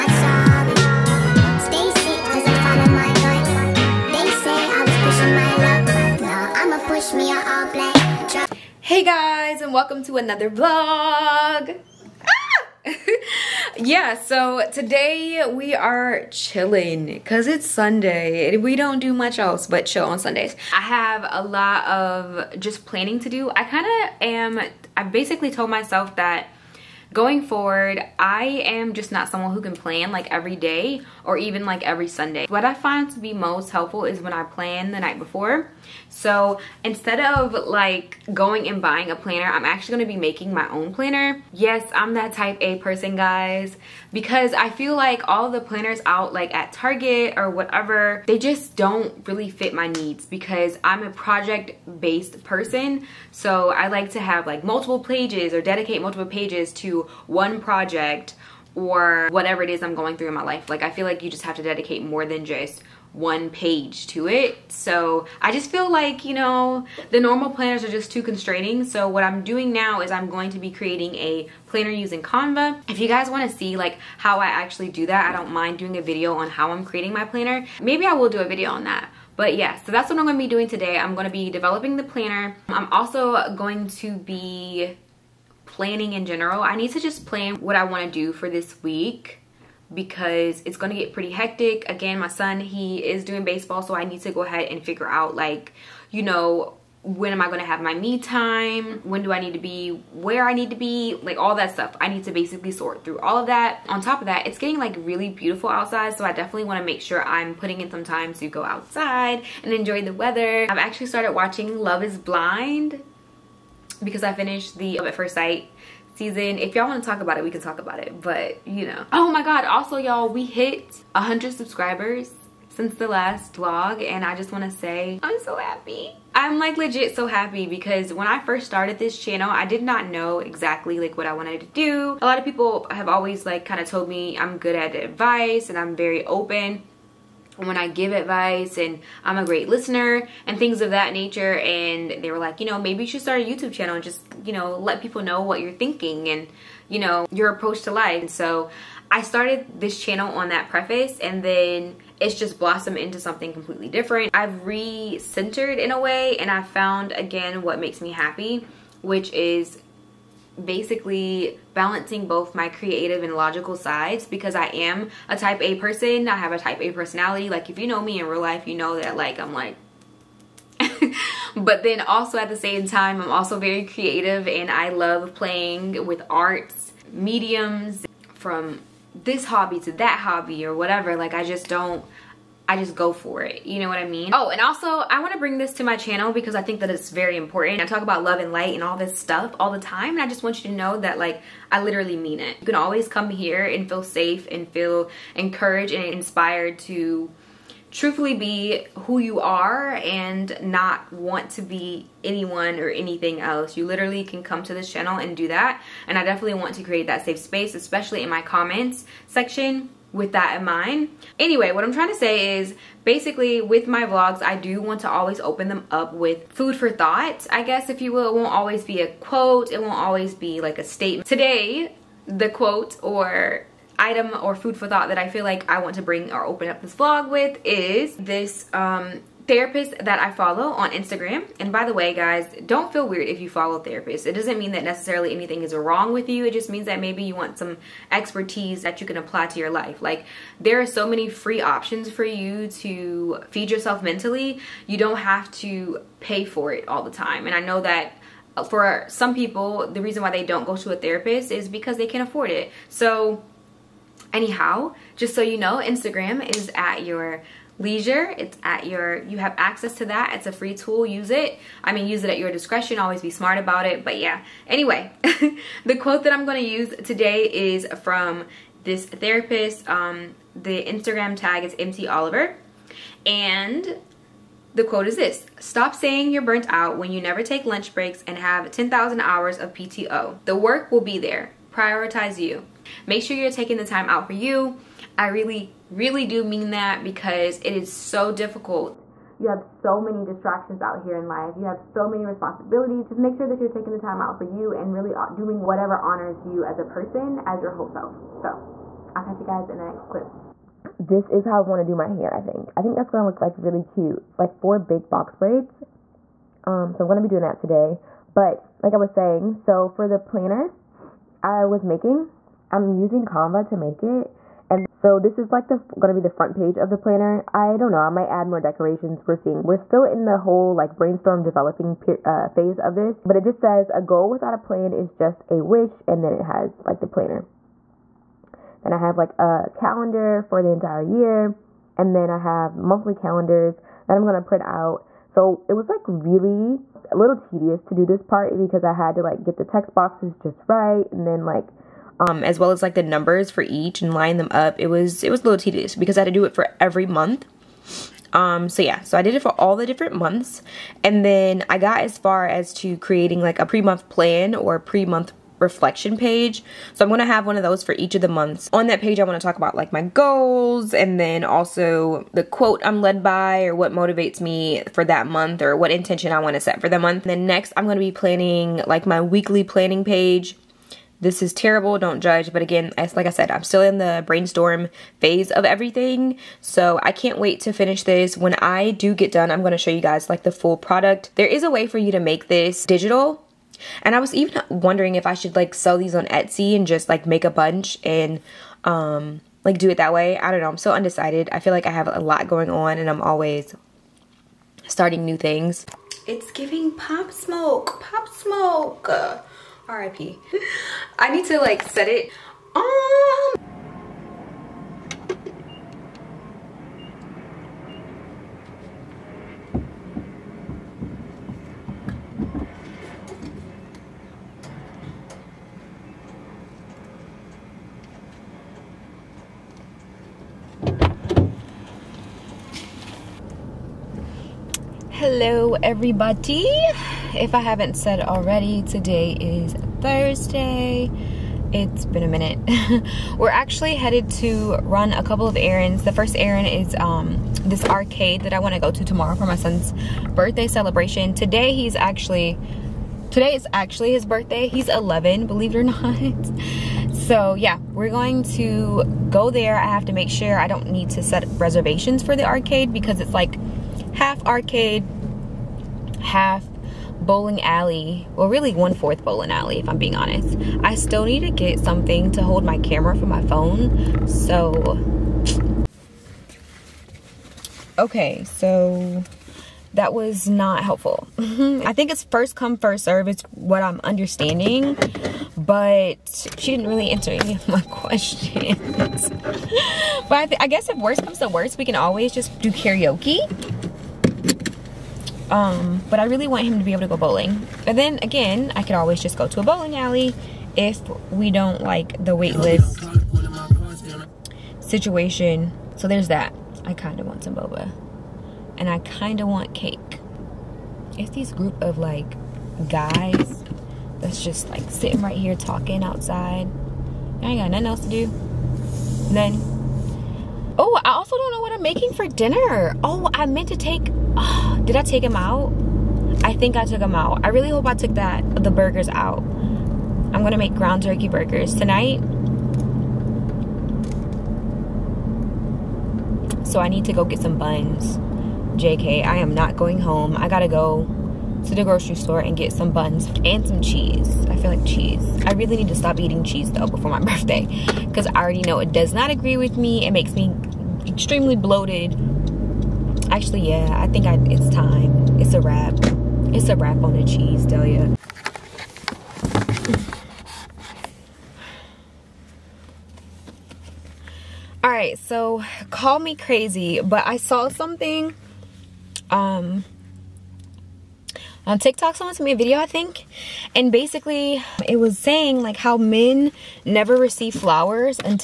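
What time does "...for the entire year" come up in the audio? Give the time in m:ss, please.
5:30.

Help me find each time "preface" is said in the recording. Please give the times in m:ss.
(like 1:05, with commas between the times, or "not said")
2:30.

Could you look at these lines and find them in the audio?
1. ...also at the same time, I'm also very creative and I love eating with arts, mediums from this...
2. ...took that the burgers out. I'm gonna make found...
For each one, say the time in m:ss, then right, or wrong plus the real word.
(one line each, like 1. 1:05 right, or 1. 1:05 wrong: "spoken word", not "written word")
1. 2:52 wrong: "playing", not "eating"
2. 8:37 wrong: "ground", not "found".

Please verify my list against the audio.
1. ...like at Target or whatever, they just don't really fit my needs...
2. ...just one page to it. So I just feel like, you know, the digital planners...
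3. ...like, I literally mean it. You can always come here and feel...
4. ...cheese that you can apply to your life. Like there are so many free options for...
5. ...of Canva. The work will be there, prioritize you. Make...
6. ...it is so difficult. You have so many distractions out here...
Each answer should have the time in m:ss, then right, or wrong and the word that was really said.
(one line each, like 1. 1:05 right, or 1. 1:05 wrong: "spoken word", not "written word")
1. 0:46 right
2. 1:02 wrong: "normal", not "digital"
3. 3:11 right
4. 3:58 wrong: "expertise", not "cheese"
5. 4:39 wrong: "PTO", not "Canva"
6. 4:47 right.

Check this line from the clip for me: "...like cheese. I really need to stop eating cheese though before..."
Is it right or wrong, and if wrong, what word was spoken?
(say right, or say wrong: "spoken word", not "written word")
right.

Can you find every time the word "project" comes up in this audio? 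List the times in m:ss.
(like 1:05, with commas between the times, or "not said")
0:51, 0:57.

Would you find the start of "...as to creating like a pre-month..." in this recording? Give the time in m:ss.
5:52.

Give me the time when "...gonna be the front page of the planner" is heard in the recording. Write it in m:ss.
5:15.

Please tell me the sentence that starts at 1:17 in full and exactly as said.
Maybe I will do a video on that.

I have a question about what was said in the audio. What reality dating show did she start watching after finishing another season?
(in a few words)
Love is Blind.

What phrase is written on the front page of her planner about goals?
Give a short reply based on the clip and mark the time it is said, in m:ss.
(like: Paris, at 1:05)
A goal without a plan is just a wish, at 5:23.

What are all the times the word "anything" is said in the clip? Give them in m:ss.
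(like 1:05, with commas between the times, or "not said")
3:22, 3:55.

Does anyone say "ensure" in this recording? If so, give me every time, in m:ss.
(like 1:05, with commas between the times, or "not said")
not said.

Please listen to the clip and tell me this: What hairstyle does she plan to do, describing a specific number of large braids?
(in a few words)
four big box braids.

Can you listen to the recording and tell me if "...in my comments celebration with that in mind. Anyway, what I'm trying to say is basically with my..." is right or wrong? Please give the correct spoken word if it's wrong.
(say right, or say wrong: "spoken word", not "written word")
wrong: "section", not "celebration".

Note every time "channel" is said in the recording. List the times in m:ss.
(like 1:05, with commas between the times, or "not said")
2:09, 2:23, 2:30, 3:05, 3:24.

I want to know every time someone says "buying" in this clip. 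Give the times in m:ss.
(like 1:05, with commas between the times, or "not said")
0:38.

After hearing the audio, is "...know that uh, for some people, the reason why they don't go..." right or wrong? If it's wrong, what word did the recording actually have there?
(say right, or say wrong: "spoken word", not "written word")
right.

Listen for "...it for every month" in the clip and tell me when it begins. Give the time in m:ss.
5:46.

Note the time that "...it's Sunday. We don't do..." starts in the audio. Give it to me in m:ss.
0:17.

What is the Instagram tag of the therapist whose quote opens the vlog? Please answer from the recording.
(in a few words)
MT Oliver.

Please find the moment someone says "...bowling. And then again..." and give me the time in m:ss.
8:07.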